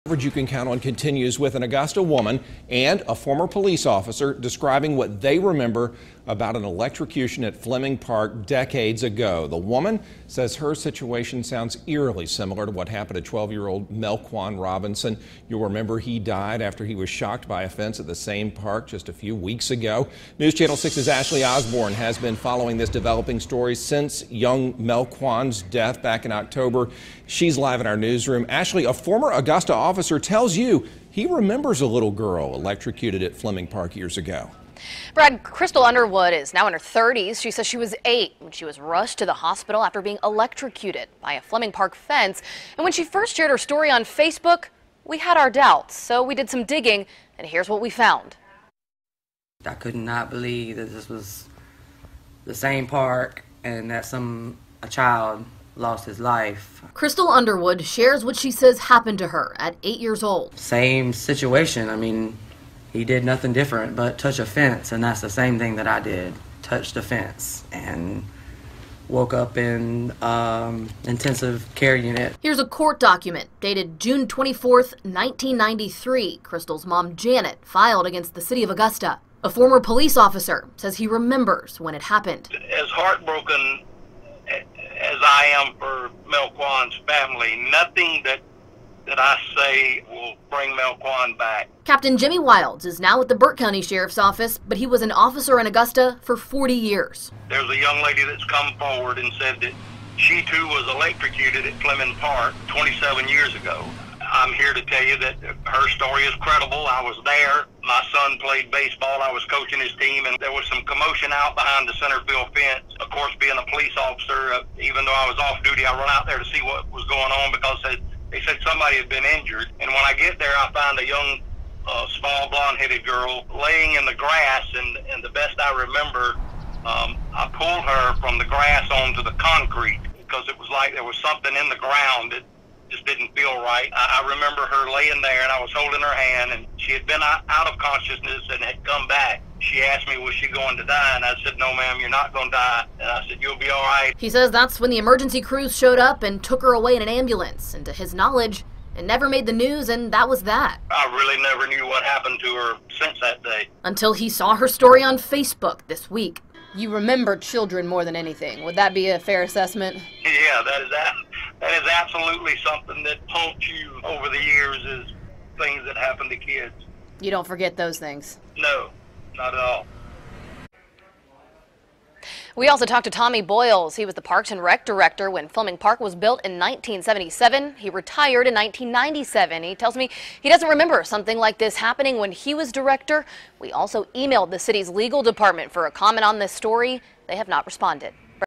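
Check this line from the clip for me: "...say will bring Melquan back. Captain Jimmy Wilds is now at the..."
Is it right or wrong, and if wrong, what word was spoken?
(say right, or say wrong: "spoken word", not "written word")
right.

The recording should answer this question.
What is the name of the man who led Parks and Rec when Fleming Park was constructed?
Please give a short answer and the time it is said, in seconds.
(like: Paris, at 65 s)
Tommy Boyles, at 173 s.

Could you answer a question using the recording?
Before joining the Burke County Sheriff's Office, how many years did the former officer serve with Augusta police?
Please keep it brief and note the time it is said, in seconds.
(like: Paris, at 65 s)
40, at 96 s.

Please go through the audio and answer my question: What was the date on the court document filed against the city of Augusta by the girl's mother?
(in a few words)
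June 24, 1993.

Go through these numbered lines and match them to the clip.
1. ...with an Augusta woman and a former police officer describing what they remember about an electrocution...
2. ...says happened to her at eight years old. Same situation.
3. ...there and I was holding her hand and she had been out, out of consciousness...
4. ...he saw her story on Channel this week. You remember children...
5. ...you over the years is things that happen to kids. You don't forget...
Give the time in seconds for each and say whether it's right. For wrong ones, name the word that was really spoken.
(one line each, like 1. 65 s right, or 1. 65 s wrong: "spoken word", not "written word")
1. 1 s right
2. 58 s right
3. 135 s right
4. 154 s wrong: "Facebook", not "Channel"
5. 163 s right.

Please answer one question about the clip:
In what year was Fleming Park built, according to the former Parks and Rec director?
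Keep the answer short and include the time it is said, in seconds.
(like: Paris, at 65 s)
1977, at 176 s.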